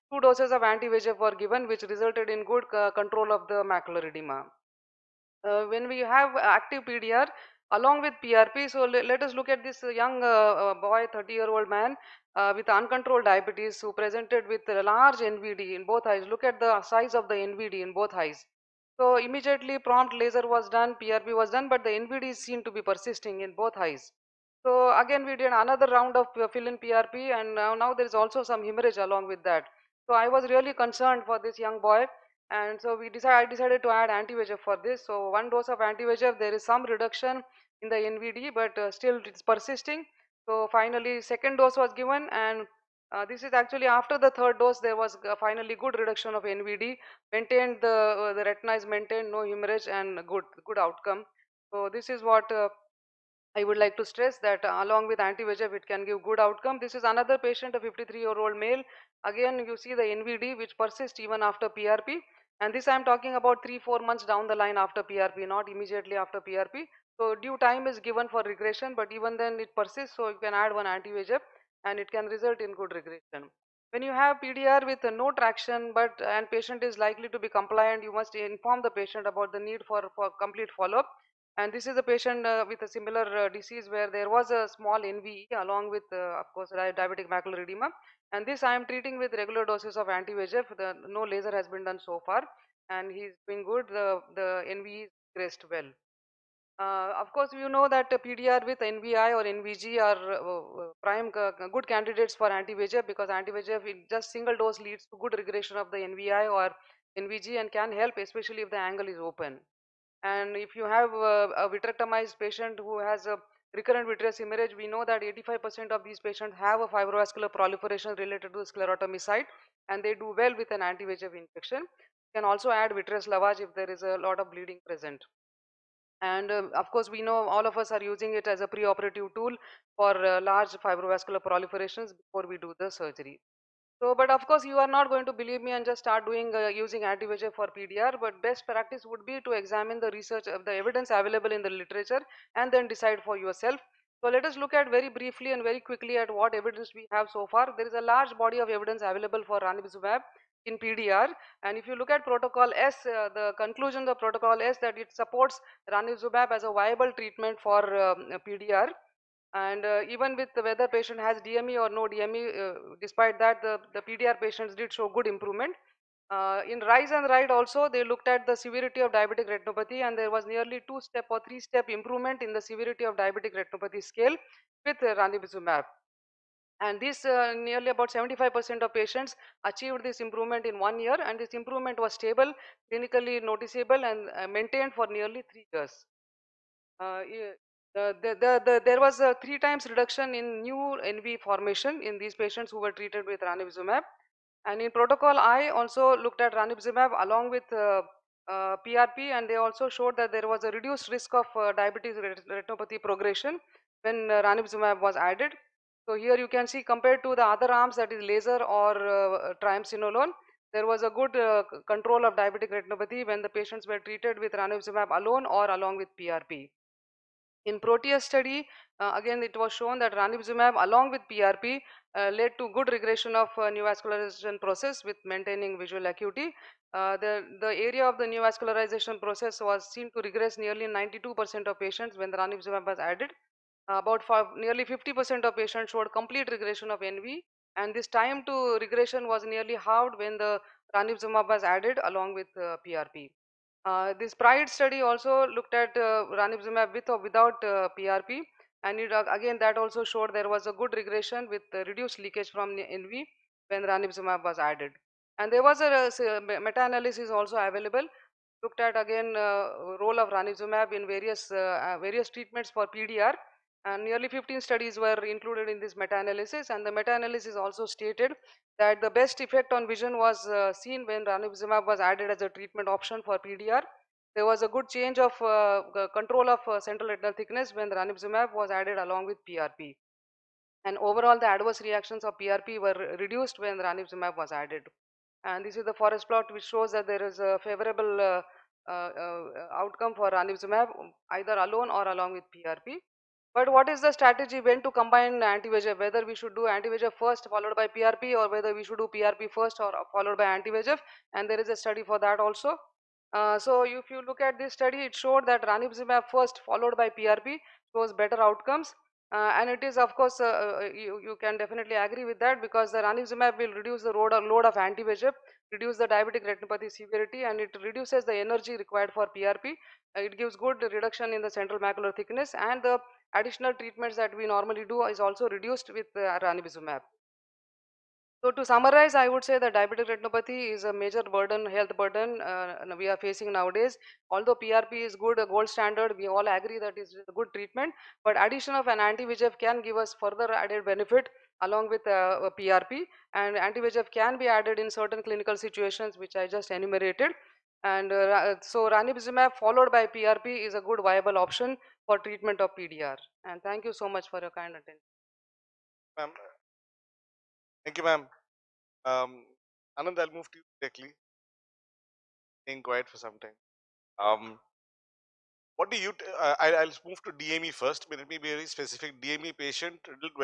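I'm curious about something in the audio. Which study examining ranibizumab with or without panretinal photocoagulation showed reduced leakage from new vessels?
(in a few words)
PRIDE.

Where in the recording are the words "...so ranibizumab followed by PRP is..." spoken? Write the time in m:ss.
5:48.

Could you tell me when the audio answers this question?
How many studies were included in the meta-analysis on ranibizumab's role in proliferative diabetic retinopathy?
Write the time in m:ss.
4:24.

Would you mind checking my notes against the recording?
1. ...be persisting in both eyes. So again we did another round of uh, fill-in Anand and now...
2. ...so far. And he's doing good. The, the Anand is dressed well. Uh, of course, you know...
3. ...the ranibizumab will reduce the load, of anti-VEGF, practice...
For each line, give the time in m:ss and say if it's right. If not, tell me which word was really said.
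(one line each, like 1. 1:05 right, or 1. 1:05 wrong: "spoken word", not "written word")
1. 0:22 wrong: "PRP", not "Anand"
2. 1:32 wrong: "NVE", not "Anand"
3. 5:12 wrong: "reduce", not "practice".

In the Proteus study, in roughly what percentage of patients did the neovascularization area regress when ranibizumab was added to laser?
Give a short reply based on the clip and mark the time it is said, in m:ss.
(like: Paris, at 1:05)
92%, at 3:50.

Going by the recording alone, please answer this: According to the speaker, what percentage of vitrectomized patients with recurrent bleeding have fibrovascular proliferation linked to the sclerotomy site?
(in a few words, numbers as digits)
85%.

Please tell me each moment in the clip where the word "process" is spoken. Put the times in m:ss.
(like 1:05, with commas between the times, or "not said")
3:44, 3:49.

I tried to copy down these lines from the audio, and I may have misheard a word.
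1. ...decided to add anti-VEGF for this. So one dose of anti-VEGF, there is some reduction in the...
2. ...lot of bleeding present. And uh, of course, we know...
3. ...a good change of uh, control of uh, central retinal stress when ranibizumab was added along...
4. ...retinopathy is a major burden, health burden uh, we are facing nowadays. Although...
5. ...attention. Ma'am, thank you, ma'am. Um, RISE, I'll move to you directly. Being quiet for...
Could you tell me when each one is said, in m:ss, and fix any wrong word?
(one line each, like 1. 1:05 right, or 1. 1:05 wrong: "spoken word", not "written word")
1. 0:33 right
2. 2:04 right
3. 4:34 wrong: "thickness", not "stress"
4. 5:30 right
5. 5:54 wrong: "Anand", not "RISE".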